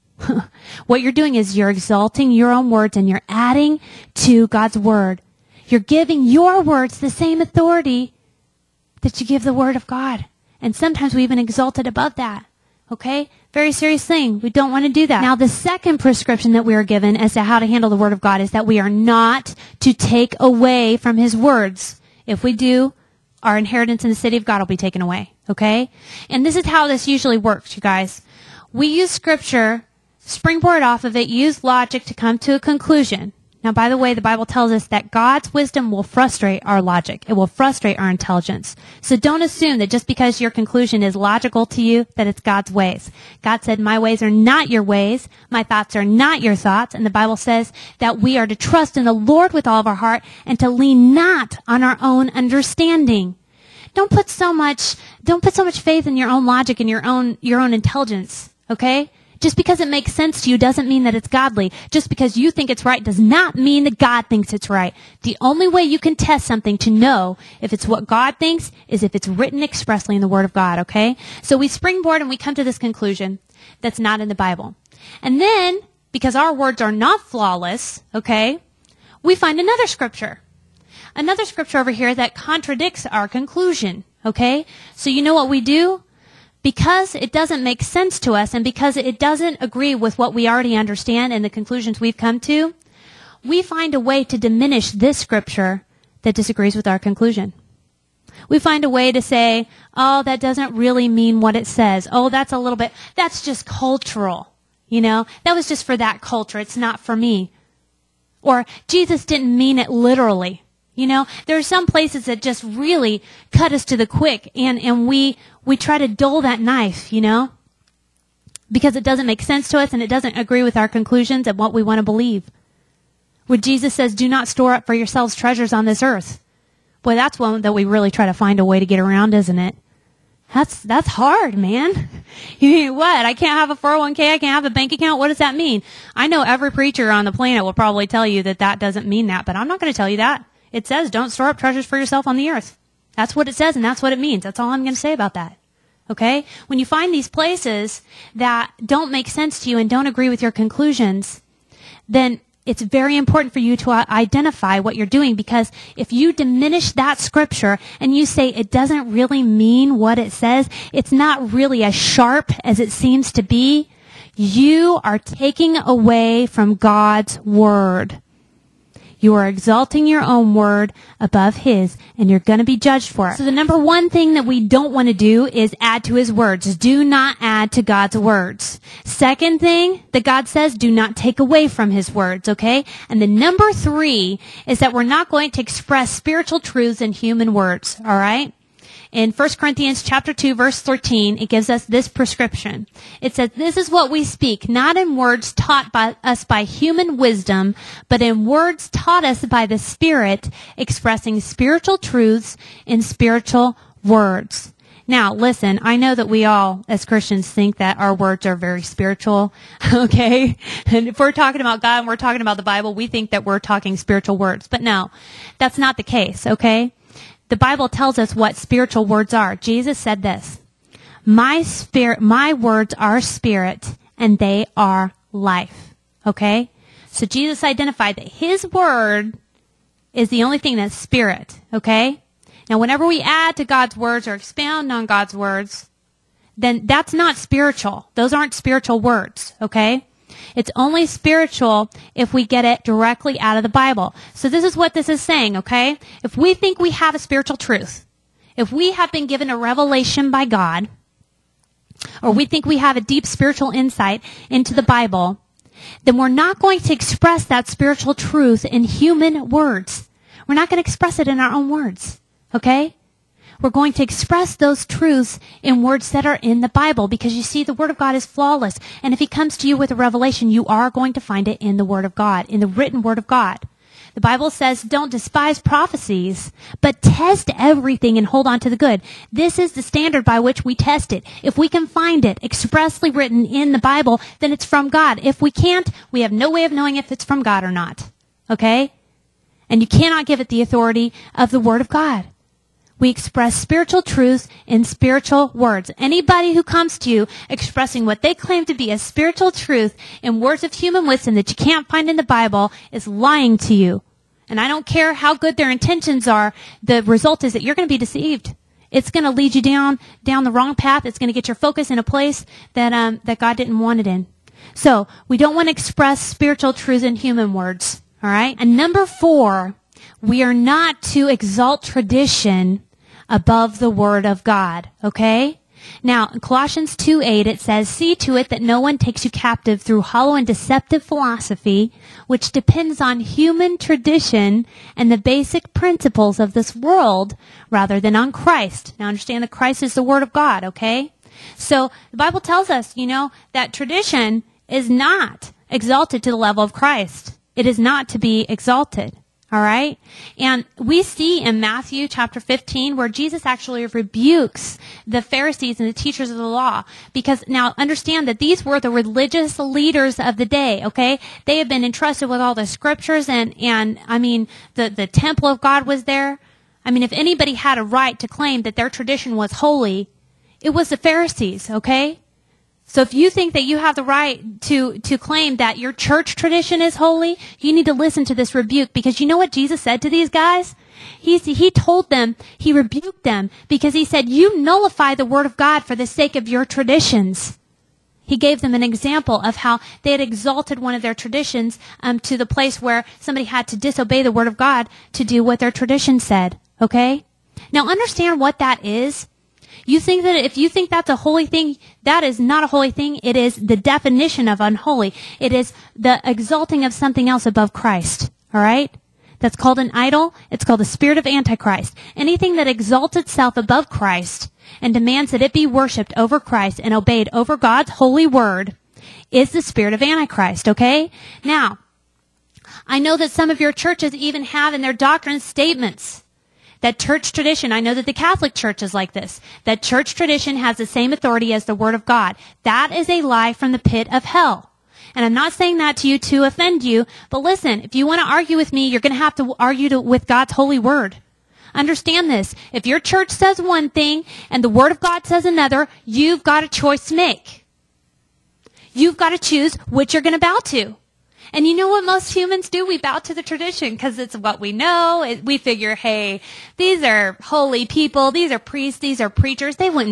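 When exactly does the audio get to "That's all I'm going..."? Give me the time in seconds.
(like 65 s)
144 s.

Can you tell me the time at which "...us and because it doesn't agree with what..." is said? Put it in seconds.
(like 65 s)
88 s.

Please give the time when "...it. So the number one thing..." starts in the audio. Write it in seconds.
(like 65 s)
173 s.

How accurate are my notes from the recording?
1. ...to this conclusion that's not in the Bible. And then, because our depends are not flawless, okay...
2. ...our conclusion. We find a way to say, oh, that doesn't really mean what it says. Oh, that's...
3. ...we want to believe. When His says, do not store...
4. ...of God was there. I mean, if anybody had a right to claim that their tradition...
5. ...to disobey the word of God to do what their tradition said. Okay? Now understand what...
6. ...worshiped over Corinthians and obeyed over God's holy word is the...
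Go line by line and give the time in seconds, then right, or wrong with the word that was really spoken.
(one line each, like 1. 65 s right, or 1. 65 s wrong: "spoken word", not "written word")
1. 72 s wrong: "words", not "depends"
2. 96 s right
3. 121 s wrong: "Jesus", not "His"
4. 365 s right
5. 393 s right
6. 415 s wrong: "Christ", not "Corinthians".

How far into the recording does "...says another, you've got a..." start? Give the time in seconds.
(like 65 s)
445 s.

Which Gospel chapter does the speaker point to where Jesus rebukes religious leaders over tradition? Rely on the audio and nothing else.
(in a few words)
Matthew chapter 15.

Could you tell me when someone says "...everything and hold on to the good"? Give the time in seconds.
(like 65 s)
277 s.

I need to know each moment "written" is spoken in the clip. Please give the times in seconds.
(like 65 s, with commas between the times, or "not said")
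69 s, 272 s, 283 s.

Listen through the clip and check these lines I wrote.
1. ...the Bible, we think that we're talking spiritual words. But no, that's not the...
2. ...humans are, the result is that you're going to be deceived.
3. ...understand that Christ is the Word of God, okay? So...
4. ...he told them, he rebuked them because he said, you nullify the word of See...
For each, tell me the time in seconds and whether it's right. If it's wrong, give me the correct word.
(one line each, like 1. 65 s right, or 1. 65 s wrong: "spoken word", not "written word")
1. 212 s right
2. 305 s wrong: "intentions", not "humans"
3. 339 s right
4. 381 s wrong: "God", not "See".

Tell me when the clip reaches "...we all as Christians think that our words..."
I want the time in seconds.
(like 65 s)
206 s.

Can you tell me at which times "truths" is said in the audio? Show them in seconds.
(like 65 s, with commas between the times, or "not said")
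186 s, 201 s, 247 s, 258 s, 264 s, 294 s, 299 s, 316 s.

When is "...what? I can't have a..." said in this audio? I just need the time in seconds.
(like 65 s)
132 s.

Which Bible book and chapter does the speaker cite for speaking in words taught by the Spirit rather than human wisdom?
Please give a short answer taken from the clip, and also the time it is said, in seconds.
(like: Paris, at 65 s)
1 Corinthians chapter 2, at 189 s.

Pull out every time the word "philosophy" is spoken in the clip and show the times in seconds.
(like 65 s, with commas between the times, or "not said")
331 s.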